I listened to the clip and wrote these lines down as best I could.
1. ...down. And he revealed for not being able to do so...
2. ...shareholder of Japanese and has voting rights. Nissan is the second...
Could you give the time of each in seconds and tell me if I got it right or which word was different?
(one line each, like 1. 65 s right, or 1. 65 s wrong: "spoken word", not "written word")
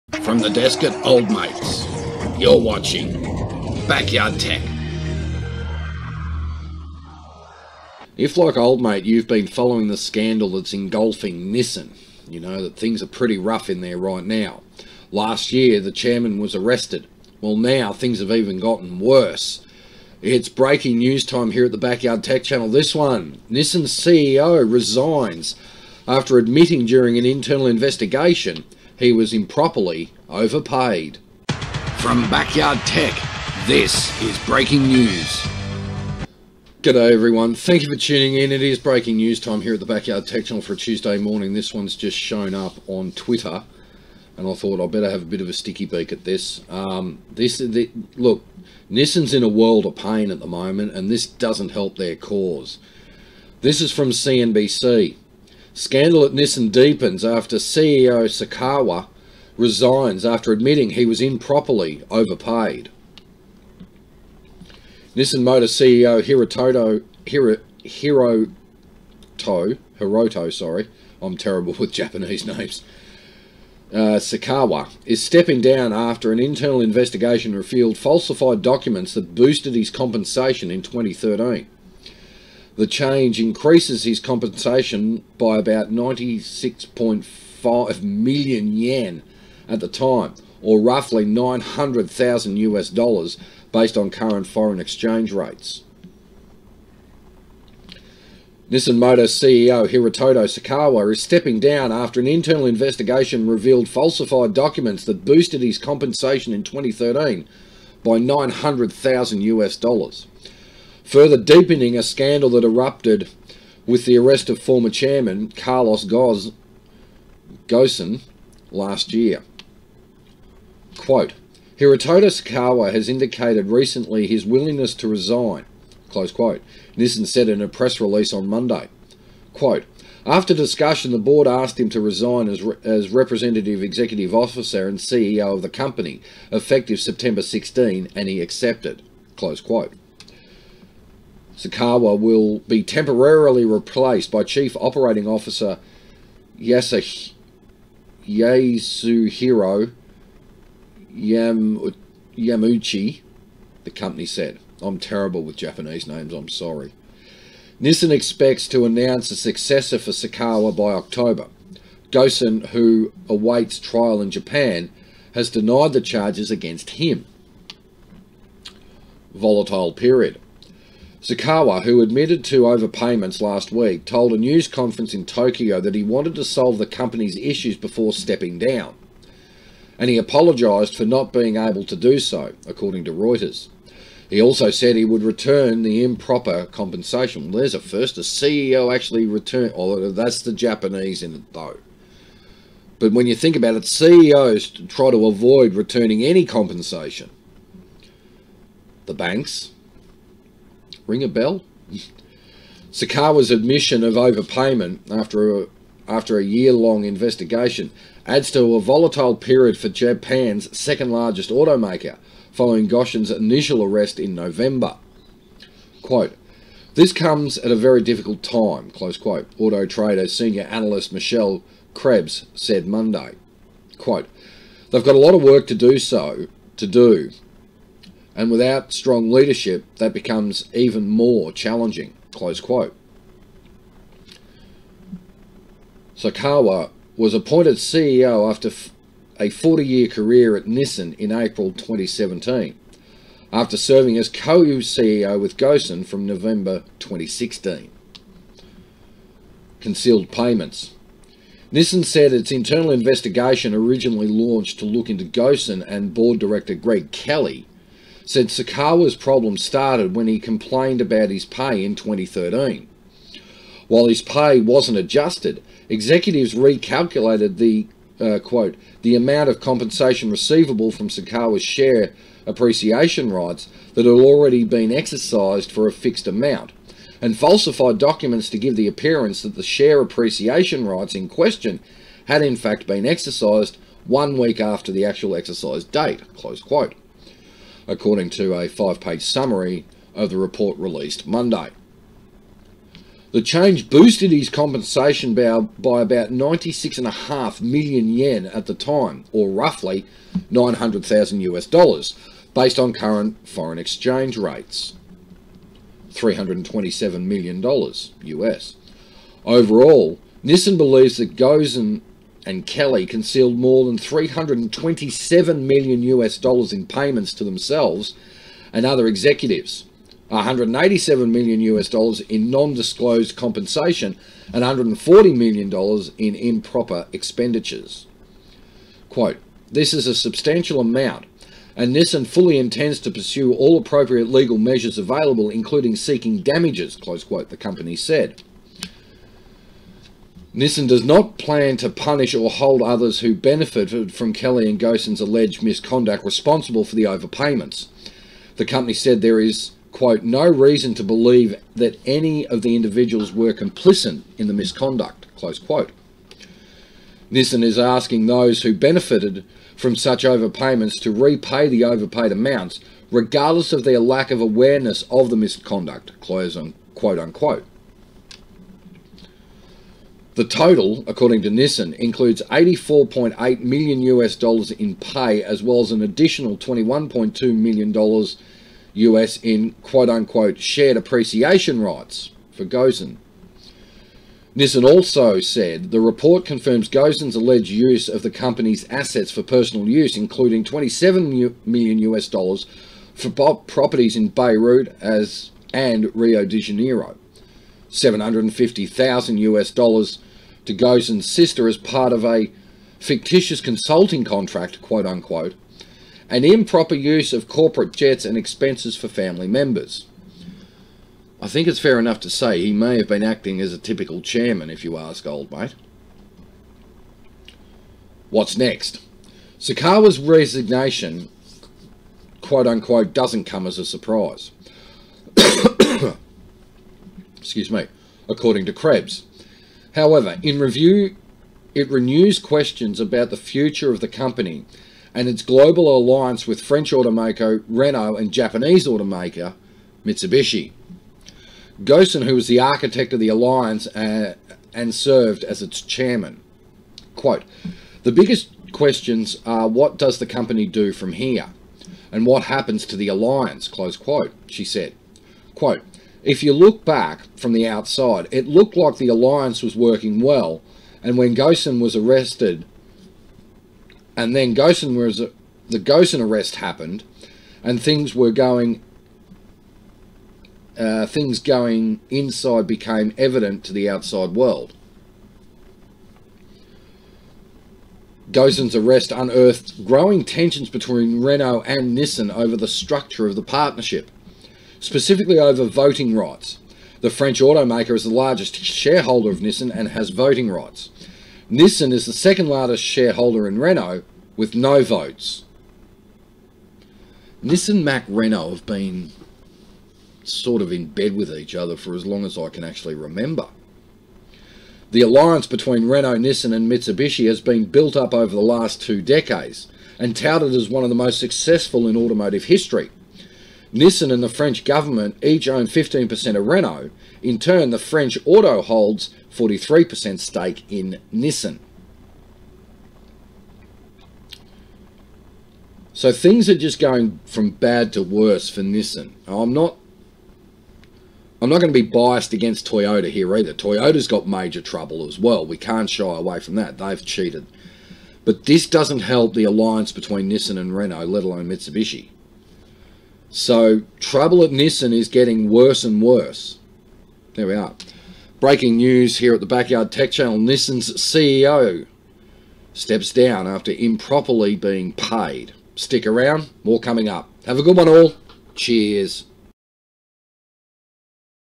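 1. 178 s wrong: "apologised", not "revealed"
2. 488 s wrong: "Nissan", not "Japanese".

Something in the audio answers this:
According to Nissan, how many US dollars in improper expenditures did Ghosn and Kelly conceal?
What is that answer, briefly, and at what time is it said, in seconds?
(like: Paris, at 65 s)
$140 million, at 324 s.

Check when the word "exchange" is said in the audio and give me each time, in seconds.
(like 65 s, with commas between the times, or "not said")
94 s, 303 s.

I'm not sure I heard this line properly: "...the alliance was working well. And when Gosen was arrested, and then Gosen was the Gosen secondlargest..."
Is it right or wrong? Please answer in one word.
wrong.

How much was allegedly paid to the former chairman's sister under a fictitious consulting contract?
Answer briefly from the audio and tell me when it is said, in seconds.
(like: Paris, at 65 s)
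$750,000, at 397 s.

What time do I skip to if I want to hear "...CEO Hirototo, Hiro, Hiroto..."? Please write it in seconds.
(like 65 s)
65 s.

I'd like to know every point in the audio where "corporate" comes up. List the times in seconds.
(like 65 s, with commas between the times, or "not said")
407 s.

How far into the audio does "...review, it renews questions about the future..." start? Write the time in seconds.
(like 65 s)
430 s.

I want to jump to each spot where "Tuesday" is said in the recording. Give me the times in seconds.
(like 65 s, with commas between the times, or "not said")
40 s.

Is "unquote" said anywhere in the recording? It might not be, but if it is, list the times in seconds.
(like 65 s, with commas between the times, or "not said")
367 s, 380 s, 405 s, 422 s.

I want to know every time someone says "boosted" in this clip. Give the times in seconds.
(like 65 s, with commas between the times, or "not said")
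79 s, 105 s, 293 s.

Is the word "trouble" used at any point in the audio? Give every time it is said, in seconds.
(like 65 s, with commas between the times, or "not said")
534 s, 544 s.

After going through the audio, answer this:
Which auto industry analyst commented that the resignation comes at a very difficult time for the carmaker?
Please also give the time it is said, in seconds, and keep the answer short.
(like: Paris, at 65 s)
Michelle Krebs, at 221 s.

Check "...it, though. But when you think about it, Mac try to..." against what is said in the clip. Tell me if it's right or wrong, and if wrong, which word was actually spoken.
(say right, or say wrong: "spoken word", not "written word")
wrong: "CEOs", not "Mac".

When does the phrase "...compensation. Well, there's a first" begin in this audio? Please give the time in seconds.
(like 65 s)
186 s.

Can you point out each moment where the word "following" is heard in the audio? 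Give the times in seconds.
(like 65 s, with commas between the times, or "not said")
9 s, 212 s.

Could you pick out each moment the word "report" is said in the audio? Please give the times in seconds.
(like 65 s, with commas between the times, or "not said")
290 s, 386 s.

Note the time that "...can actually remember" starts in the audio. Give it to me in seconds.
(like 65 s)
502 s.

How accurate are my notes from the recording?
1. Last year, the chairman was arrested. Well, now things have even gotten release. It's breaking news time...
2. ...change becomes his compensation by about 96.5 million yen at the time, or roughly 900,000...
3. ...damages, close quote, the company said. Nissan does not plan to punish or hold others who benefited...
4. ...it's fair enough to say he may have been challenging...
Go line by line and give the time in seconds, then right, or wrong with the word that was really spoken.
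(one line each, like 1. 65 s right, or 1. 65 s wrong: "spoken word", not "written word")
1. 15 s wrong: "worse", not "release"
2. 82 s wrong: "increases", not "becomes"
3. 336 s right
4. 411 s wrong: "acting", not "challenging".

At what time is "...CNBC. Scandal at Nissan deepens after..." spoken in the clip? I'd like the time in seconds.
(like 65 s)
54 s.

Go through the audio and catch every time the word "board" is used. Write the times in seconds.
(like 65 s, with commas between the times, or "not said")
131 s, 256 s.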